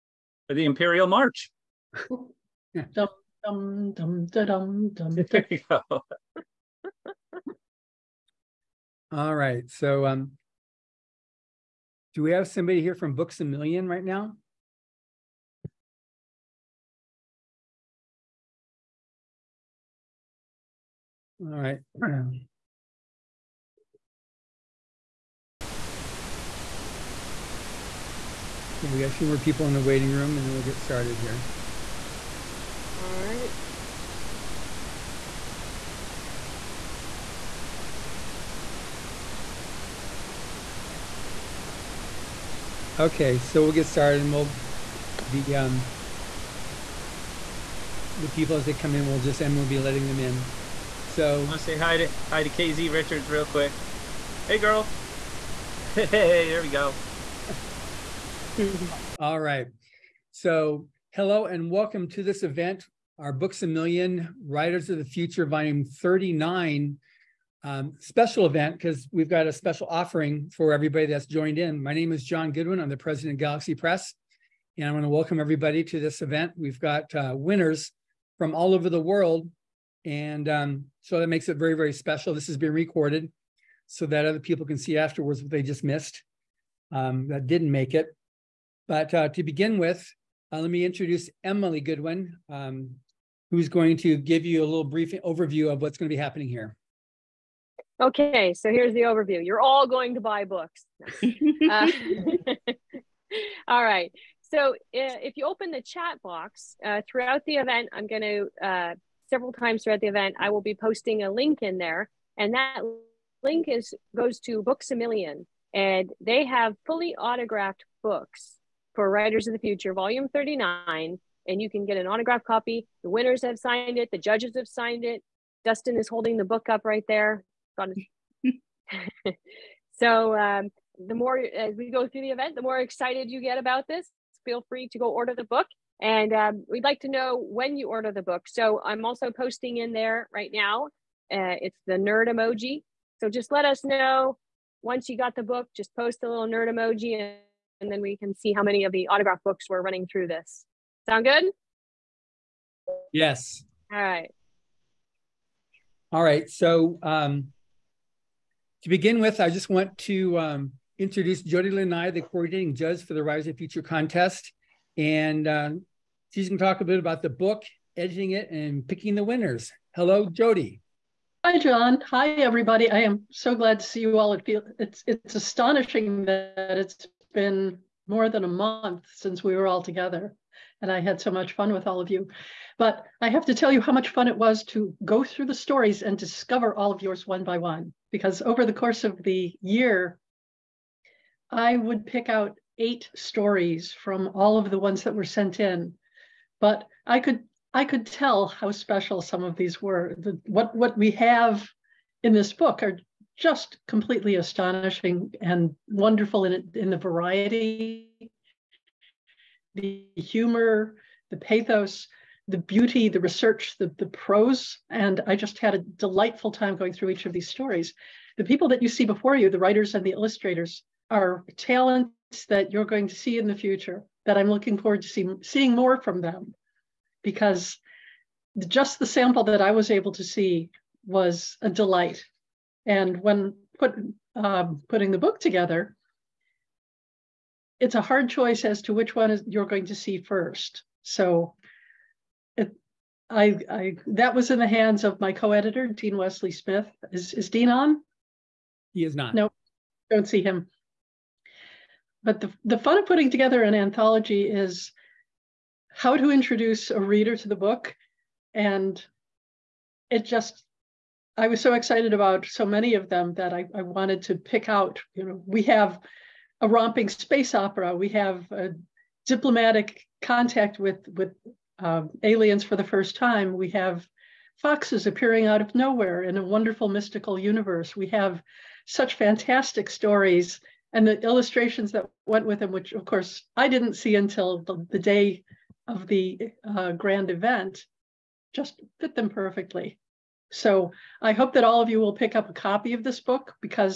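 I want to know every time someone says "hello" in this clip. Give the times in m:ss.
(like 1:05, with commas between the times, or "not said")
1:01, 2:49.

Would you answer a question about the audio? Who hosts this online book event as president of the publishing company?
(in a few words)
John Goodwin.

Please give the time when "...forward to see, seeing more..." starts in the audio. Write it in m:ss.
3:44.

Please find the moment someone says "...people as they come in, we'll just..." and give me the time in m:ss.
0:48.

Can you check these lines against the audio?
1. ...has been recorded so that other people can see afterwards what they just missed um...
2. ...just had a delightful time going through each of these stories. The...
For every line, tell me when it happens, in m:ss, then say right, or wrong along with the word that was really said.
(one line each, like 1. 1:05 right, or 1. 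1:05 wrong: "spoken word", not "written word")
1. 1:22 right
2. 3:35 right.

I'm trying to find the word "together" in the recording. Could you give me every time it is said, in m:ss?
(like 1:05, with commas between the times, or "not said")
2:59, 3:55, 4:13.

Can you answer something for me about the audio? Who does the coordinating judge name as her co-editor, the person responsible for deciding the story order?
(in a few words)
Dean Wesley Smith.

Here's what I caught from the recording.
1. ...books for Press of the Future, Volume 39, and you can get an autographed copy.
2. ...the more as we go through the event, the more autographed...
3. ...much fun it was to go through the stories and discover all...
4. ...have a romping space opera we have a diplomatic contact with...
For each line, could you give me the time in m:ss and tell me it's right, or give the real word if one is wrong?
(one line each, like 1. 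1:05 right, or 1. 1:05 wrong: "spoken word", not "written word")
1. 1:58 wrong: "Writers", not "Press"
2. 2:11 wrong: "excited", not "autographed"
3. 3:03 right
4. 4:25 right.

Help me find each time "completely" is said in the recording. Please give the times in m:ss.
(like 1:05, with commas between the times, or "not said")
3:23.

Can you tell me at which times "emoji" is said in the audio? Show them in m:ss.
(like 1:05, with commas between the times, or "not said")
2:22, 2:26.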